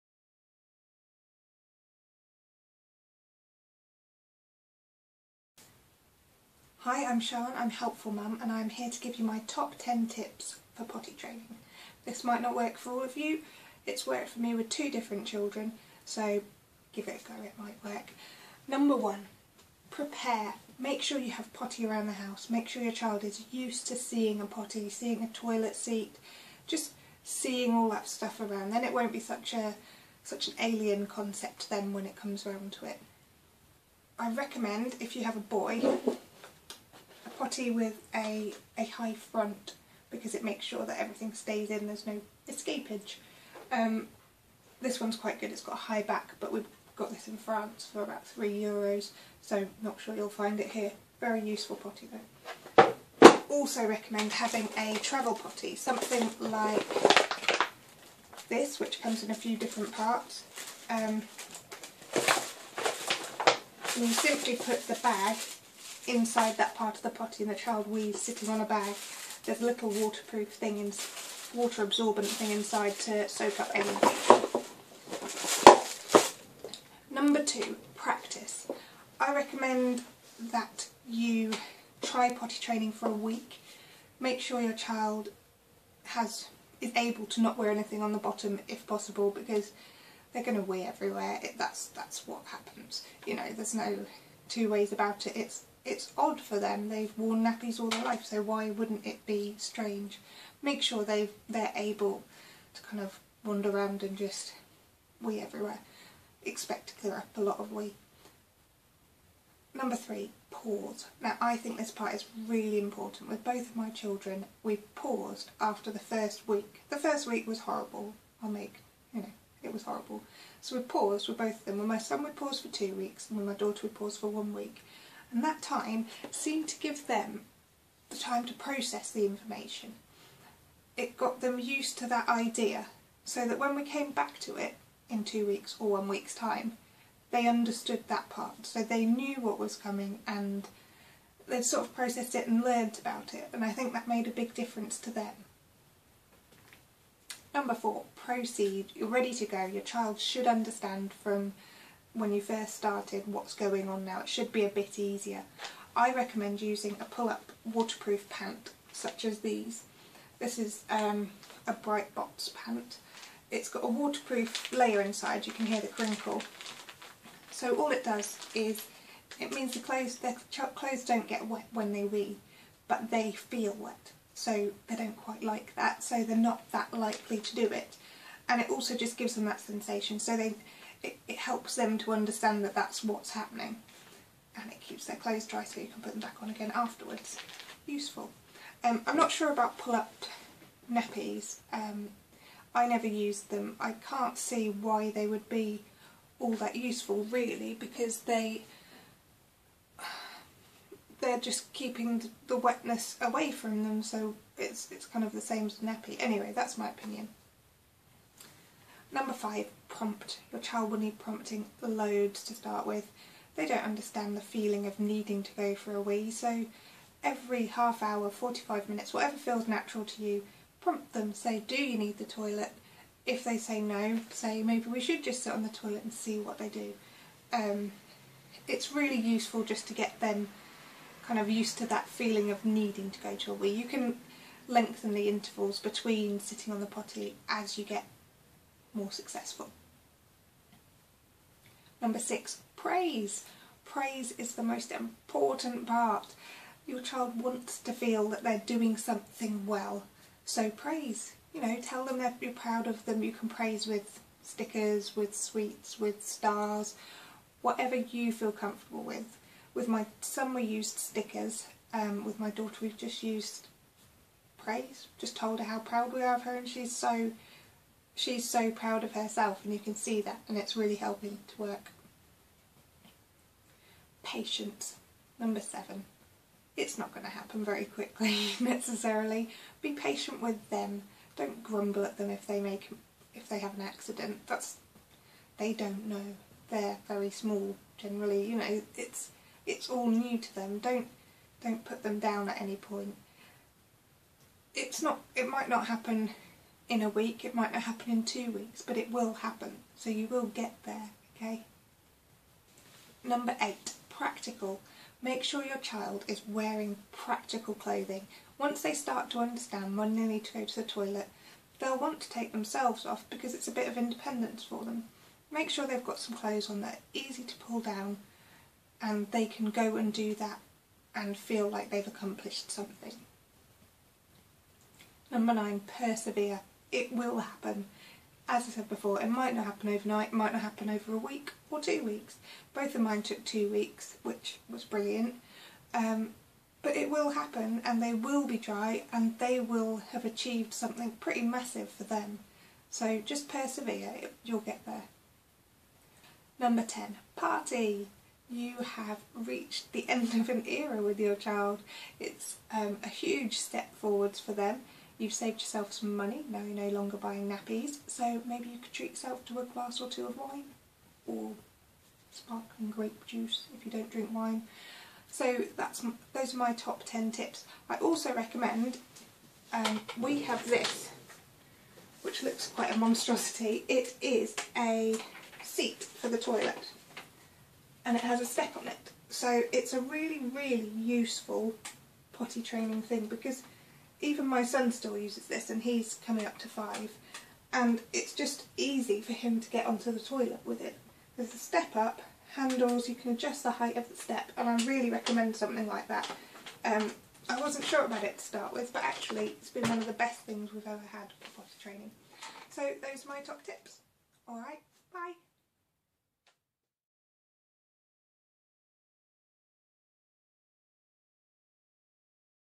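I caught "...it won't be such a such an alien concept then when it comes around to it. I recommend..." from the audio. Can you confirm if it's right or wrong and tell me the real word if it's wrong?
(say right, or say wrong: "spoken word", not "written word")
right.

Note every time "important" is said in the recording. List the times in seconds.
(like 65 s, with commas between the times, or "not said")
112 s, 244 s.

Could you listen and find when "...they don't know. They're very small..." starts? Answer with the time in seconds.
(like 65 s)
285 s.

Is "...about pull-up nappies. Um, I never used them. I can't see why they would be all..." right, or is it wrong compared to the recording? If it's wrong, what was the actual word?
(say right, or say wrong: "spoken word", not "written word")
right.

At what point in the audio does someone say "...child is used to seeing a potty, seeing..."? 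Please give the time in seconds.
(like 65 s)
22 s.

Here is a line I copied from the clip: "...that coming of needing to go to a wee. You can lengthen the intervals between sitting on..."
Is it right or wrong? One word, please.
wrong.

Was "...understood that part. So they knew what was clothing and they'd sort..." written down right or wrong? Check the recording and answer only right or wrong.
wrong.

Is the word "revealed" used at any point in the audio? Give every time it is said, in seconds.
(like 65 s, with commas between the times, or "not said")
not said.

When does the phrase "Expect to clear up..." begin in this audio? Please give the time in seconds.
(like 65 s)
106 s.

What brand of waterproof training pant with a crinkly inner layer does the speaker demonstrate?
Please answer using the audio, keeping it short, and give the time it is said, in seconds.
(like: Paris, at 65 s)
Bright box, at 161 s.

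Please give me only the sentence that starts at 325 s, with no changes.
Number nine, persevere it will happen.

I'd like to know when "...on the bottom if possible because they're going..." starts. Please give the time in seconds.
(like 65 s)
88 s.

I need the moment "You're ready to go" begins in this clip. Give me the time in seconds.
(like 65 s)
148 s.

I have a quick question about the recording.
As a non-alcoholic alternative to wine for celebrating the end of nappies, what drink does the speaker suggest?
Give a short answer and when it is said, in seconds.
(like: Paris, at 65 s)
Sparkling grape juice, at 362 s.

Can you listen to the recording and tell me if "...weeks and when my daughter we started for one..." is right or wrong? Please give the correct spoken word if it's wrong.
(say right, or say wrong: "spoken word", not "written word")
wrong: "paused", not "started".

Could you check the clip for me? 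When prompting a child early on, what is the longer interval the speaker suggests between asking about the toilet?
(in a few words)
45 minutes.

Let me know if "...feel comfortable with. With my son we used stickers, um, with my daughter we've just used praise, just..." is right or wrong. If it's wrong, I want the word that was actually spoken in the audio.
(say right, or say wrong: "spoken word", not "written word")
right.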